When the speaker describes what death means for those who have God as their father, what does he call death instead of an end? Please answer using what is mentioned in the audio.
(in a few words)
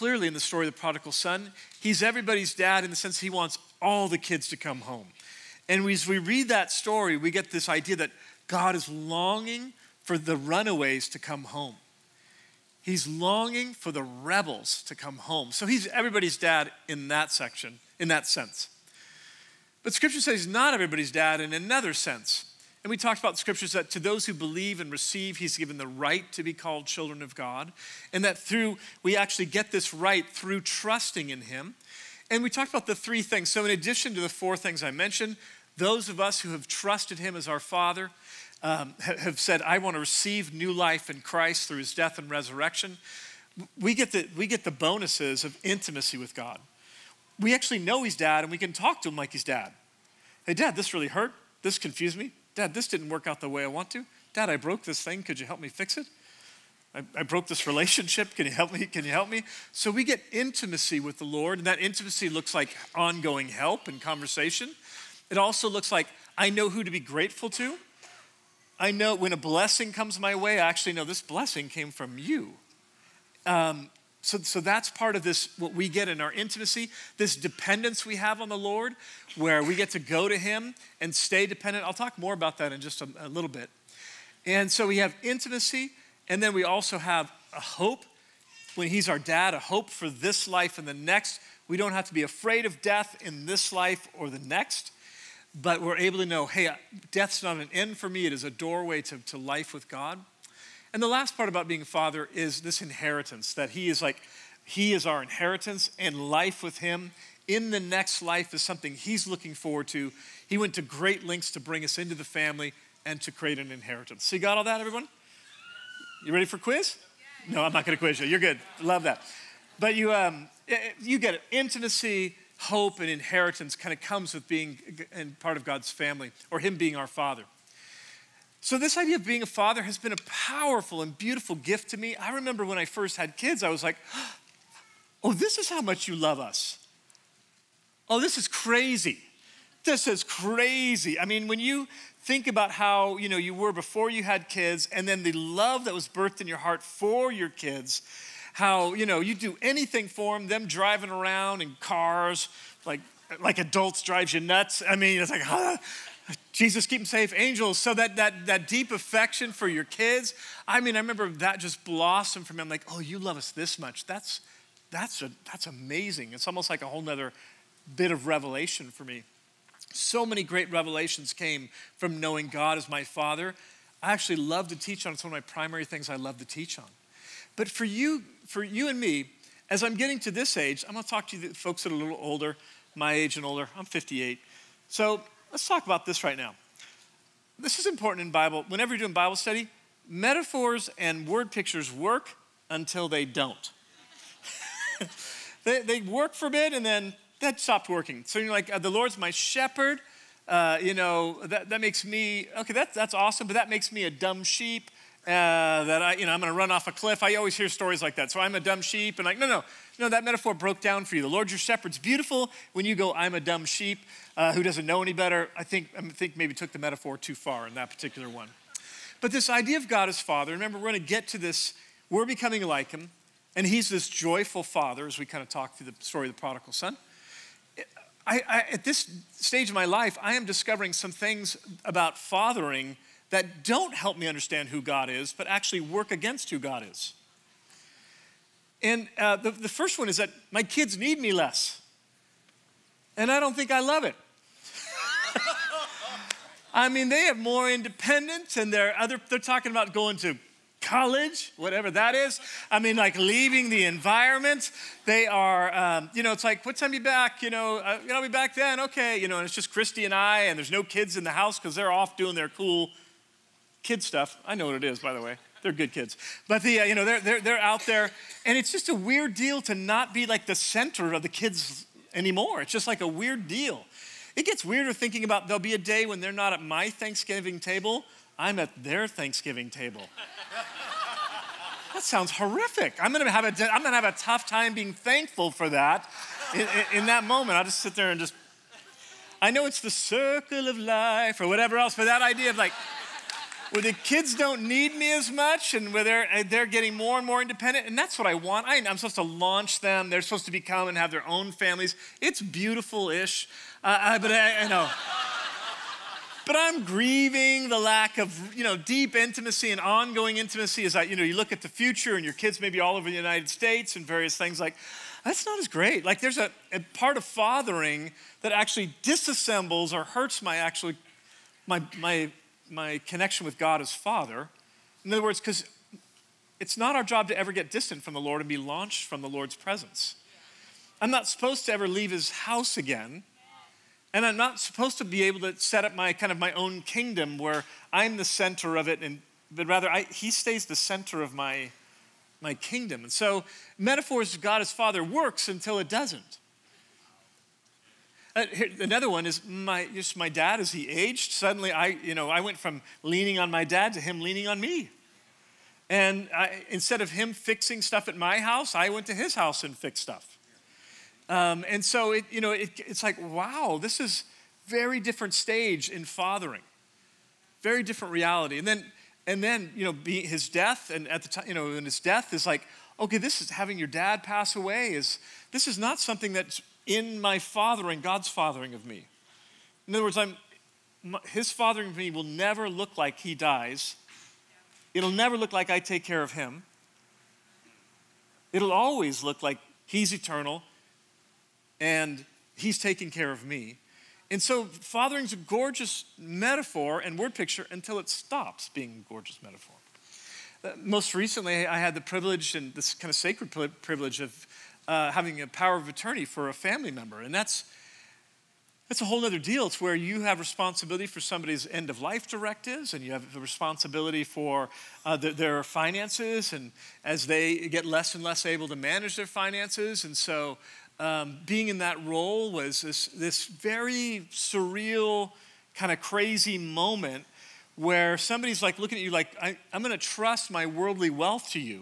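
a doorway.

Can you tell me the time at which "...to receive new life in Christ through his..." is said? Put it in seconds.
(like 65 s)
39 s.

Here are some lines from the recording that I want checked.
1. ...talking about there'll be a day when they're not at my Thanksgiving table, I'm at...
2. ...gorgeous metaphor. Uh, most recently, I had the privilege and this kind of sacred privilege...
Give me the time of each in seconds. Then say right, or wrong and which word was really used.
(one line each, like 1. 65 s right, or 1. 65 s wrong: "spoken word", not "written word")
1. 274 s wrong: "thinking", not "talking"
2. 399 s right.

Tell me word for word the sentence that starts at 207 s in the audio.
I always hear stories like that.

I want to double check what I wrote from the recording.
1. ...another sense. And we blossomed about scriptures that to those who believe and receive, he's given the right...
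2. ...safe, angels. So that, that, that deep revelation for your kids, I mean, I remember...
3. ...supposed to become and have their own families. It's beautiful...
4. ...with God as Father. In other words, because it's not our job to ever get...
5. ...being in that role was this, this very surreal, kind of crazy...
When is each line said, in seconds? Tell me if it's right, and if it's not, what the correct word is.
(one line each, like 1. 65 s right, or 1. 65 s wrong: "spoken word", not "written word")
1. 21 s wrong: "talked", not "blossomed"
2. 157 s wrong: "affection", not "revelation"
3. 300 s right
4. 323 s right
5. 421 s right.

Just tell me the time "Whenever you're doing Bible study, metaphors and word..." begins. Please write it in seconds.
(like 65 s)
188 s.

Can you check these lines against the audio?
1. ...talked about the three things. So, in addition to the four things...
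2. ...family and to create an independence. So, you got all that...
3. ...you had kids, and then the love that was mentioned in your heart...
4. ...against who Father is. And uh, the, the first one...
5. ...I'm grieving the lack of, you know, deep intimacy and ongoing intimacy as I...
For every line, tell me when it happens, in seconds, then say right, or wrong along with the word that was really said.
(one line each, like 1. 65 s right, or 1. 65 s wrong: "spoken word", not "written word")
1. 32 s right
2. 112 s wrong: "inheritance", not "independence"
3. 144 s wrong: "birthed", not "mentioned"
4. 236 s wrong: "God", not "Father"
5. 306 s right.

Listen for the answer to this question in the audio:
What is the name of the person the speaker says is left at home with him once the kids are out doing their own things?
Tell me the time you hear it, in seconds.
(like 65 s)
259 s.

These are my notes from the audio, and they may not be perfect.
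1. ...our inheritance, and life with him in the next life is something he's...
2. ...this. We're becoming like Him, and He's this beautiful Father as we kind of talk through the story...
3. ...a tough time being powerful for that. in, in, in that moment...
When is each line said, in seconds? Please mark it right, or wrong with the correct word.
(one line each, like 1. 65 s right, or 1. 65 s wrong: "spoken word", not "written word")
1. 105 s right
2. 221 s wrong: "joyful", not "beautiful"
3. 284 s wrong: "thankful", not "powerful".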